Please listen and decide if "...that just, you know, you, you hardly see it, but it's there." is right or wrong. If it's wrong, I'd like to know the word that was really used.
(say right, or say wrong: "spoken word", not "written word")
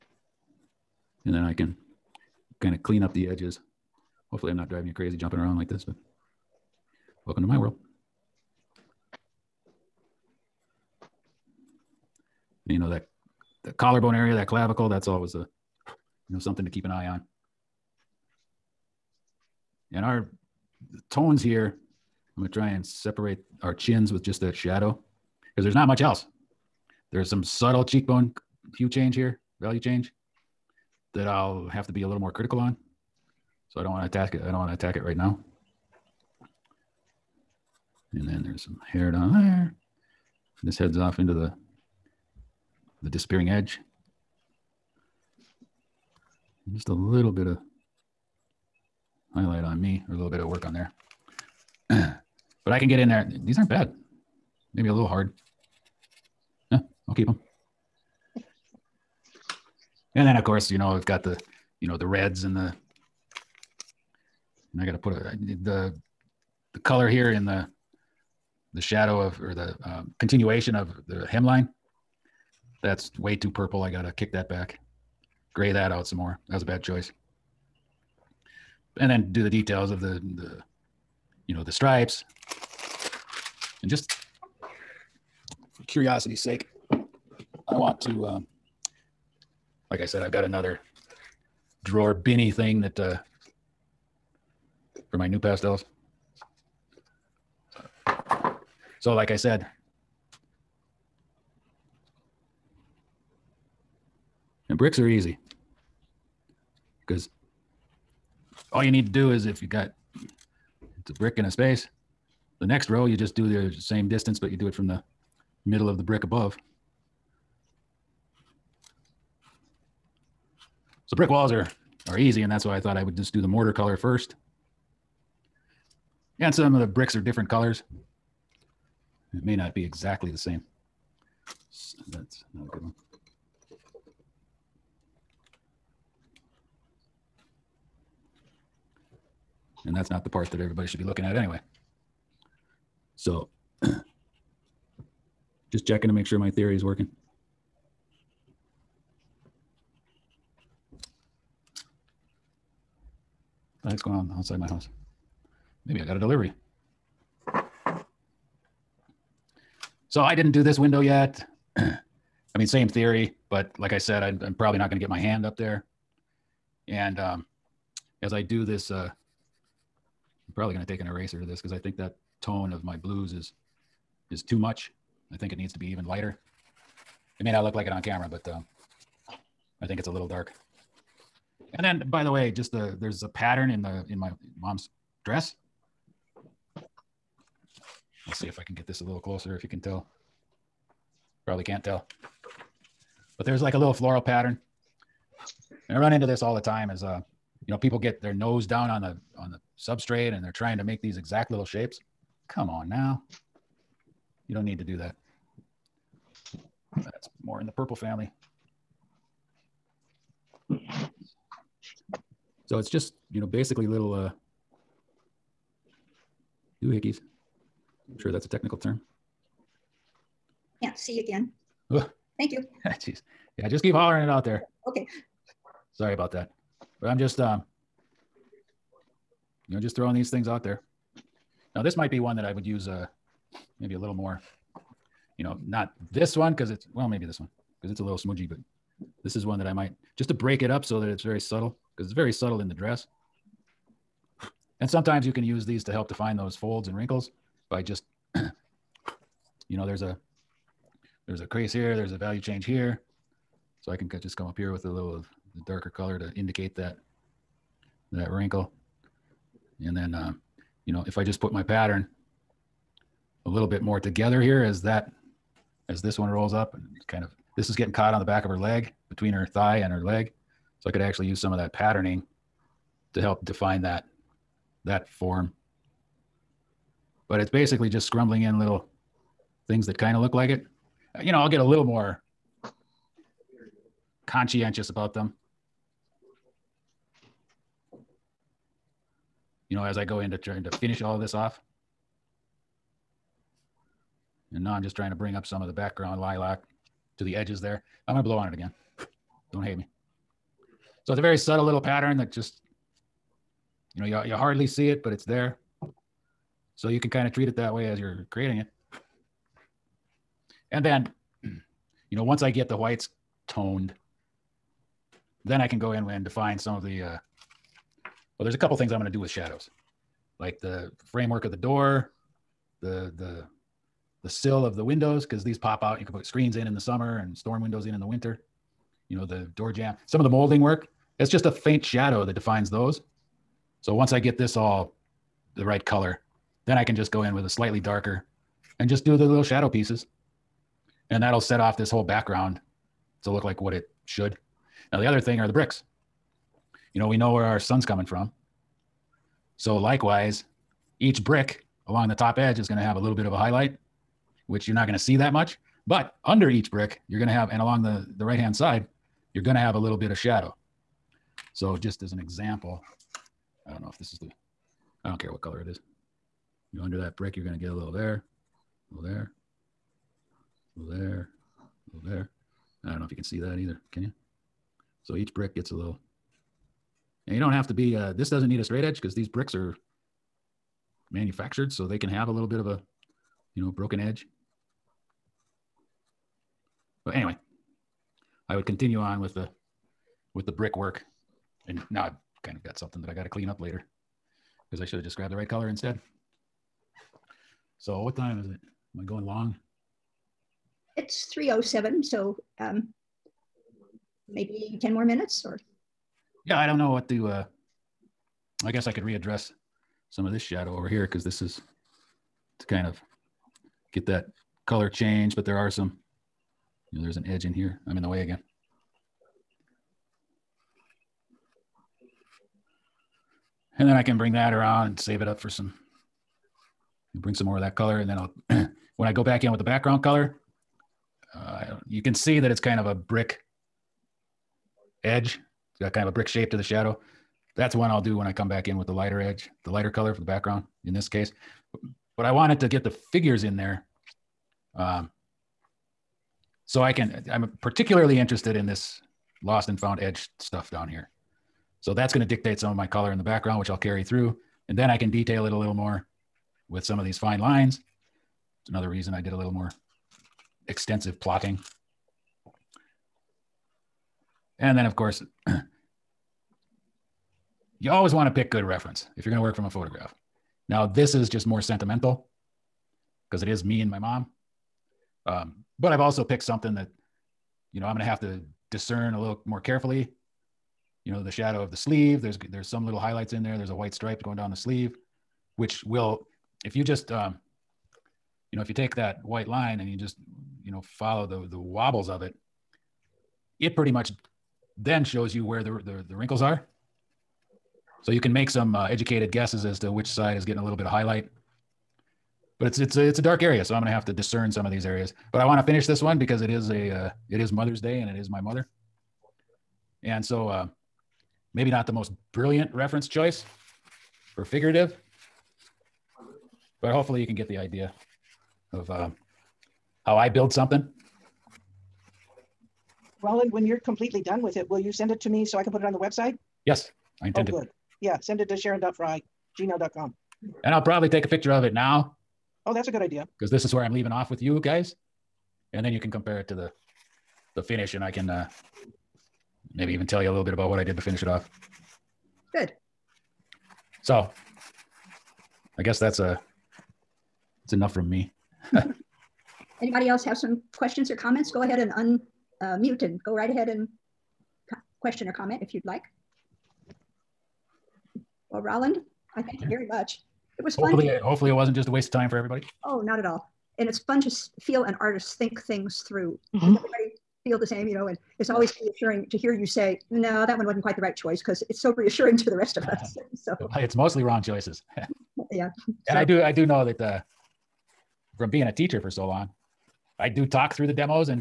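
right.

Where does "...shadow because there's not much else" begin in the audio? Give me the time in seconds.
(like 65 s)
24 s.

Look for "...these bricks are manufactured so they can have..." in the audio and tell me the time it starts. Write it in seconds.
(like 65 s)
379 s.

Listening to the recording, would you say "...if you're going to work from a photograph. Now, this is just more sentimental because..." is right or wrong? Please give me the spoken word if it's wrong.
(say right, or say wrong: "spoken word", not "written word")
right.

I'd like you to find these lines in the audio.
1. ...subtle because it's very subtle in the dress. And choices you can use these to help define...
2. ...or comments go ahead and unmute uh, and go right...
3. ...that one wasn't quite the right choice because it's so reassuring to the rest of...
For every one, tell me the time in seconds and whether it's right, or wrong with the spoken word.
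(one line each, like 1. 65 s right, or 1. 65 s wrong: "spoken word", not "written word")
1. 241 s wrong: "sometimes", not "choices"
2. 551 s right
3. 570 s right.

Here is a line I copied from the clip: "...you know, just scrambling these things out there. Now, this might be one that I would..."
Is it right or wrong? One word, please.
wrong.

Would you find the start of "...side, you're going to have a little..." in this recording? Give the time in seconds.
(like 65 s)
358 s.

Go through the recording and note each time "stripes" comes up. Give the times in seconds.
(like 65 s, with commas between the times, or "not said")
81 s, 483 s.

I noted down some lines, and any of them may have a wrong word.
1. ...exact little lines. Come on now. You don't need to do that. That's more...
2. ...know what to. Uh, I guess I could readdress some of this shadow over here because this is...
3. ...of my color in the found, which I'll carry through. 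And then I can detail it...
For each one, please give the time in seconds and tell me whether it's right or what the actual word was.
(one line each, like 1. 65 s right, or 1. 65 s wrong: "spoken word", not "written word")
1. 201 s wrong: "shapes", not "lines"
2. 406 s right
3. 452 s wrong: "background", not "found".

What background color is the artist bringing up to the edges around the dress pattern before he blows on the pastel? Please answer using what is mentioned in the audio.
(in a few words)
Lilac.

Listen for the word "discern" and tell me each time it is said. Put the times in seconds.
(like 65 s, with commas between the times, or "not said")
478 s, 504 s.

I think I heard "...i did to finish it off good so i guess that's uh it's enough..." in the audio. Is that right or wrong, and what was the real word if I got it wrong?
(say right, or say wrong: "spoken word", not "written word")
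right.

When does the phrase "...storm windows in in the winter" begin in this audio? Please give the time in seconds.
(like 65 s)
327 s.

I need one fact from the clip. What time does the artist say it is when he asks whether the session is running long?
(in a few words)
3:07.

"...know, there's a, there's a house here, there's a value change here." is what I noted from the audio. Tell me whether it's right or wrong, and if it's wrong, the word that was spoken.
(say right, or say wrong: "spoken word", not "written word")
wrong: "crease", not "house".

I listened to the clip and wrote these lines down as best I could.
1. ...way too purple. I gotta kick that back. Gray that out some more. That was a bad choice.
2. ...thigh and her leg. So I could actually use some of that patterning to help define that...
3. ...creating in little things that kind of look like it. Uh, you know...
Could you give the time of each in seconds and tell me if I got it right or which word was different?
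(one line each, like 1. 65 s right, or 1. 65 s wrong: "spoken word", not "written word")
1. 73 s right
2. 269 s right
3. 278 s wrong: "scrambling", not "creating".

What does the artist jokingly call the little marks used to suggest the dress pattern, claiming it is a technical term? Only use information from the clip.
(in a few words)
Doohickeys.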